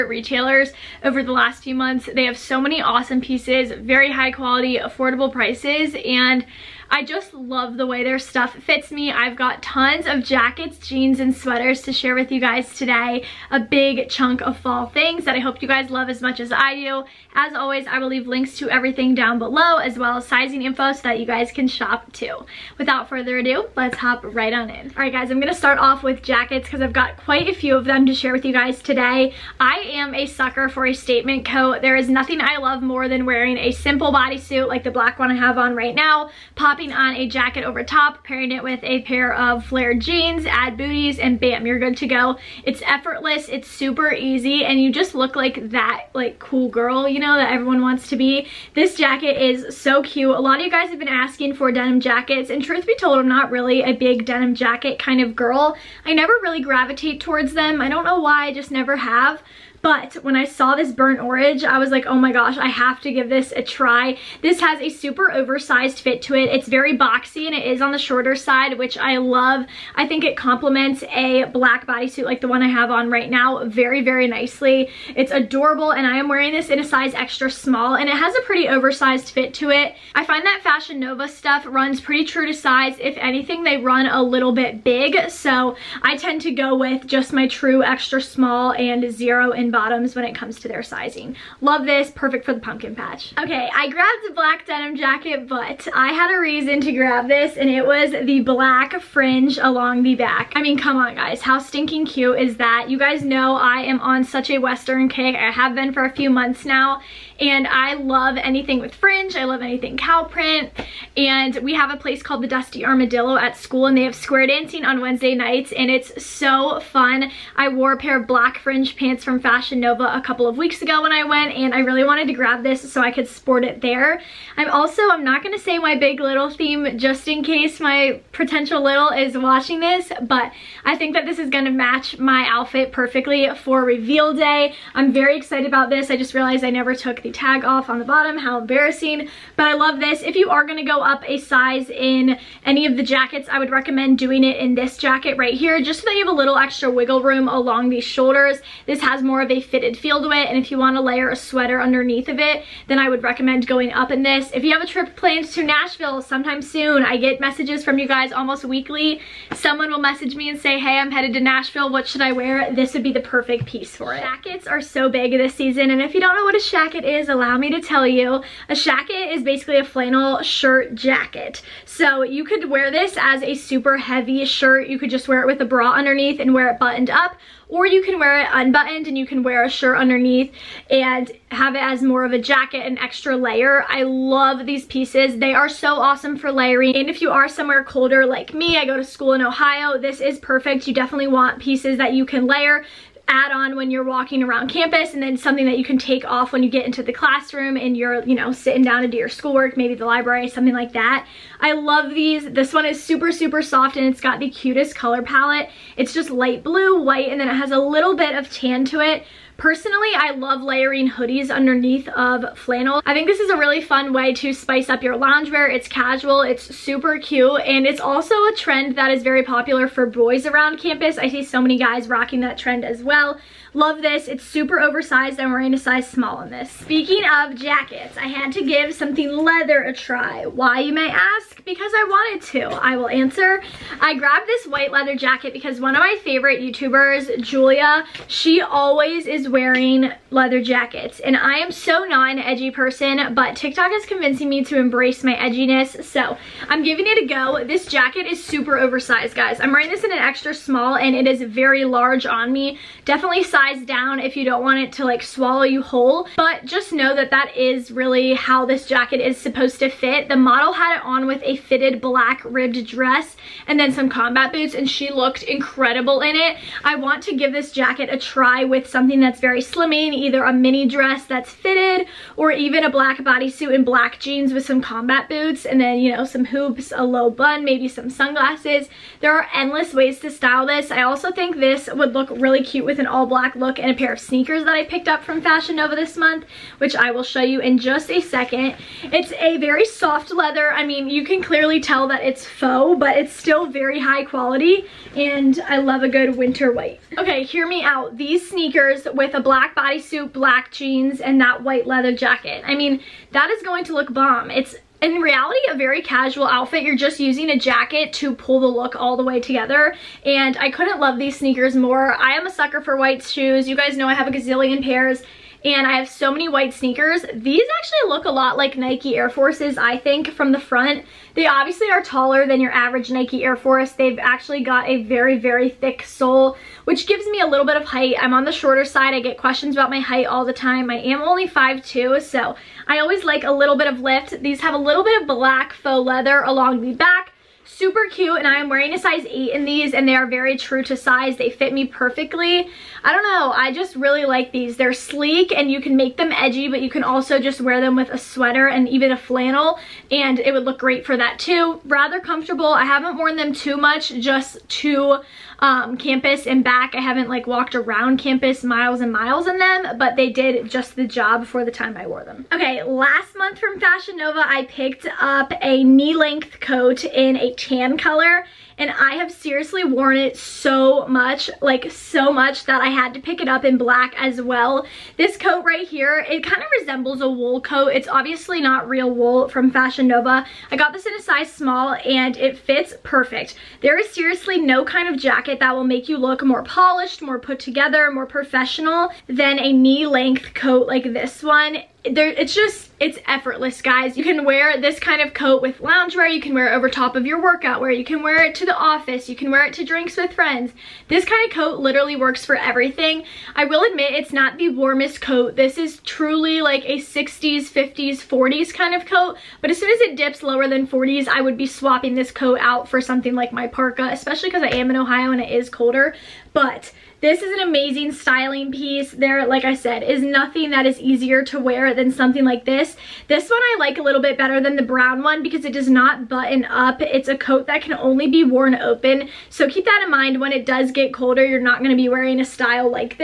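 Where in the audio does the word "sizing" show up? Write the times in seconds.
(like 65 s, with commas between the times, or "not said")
20 s, 90 s.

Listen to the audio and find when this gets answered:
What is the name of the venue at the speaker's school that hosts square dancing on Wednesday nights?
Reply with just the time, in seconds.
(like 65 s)
112 s.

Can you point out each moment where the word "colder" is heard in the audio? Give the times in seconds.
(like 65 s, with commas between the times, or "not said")
187 s, 415 s, 431 s.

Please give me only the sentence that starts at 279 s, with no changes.
There are endless ways to style this.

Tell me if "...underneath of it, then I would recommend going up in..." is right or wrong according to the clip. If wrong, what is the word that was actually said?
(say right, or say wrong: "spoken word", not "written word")
right.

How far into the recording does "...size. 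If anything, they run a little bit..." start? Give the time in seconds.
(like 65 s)
82 s.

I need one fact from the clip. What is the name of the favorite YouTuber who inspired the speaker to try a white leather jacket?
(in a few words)
Julia.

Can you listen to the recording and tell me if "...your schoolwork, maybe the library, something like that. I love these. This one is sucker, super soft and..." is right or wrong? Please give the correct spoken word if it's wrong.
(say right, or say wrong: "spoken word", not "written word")
wrong: "super", not "sucker".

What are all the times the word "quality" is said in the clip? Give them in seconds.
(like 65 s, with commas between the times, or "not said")
4 s, 294 s.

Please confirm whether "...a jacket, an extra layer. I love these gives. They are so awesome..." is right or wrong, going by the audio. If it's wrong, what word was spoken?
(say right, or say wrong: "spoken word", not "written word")
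wrong: "pieces", not "gives".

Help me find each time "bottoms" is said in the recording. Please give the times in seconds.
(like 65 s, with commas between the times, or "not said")
89 s, 138 s.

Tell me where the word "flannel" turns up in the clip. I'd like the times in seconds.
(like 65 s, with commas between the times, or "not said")
169 s, 212 s, 349 s.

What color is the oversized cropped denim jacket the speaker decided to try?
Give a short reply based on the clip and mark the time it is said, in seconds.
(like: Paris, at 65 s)
Burnt orange, at 60 s.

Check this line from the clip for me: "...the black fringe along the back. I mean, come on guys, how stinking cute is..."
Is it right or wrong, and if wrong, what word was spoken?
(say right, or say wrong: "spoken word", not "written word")
right.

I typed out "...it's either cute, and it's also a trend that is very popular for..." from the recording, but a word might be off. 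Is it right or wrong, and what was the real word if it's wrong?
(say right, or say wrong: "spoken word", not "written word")
wrong: "super", not "either".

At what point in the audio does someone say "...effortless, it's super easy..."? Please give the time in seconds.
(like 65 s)
42 s.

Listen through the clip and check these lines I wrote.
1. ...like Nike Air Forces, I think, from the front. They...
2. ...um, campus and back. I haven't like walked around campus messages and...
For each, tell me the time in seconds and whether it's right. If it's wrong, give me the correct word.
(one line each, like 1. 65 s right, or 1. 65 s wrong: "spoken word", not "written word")
1. 318 s right
2. 355 s wrong: "miles", not "messages".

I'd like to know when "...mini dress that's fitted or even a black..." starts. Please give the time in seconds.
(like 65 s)
270 s.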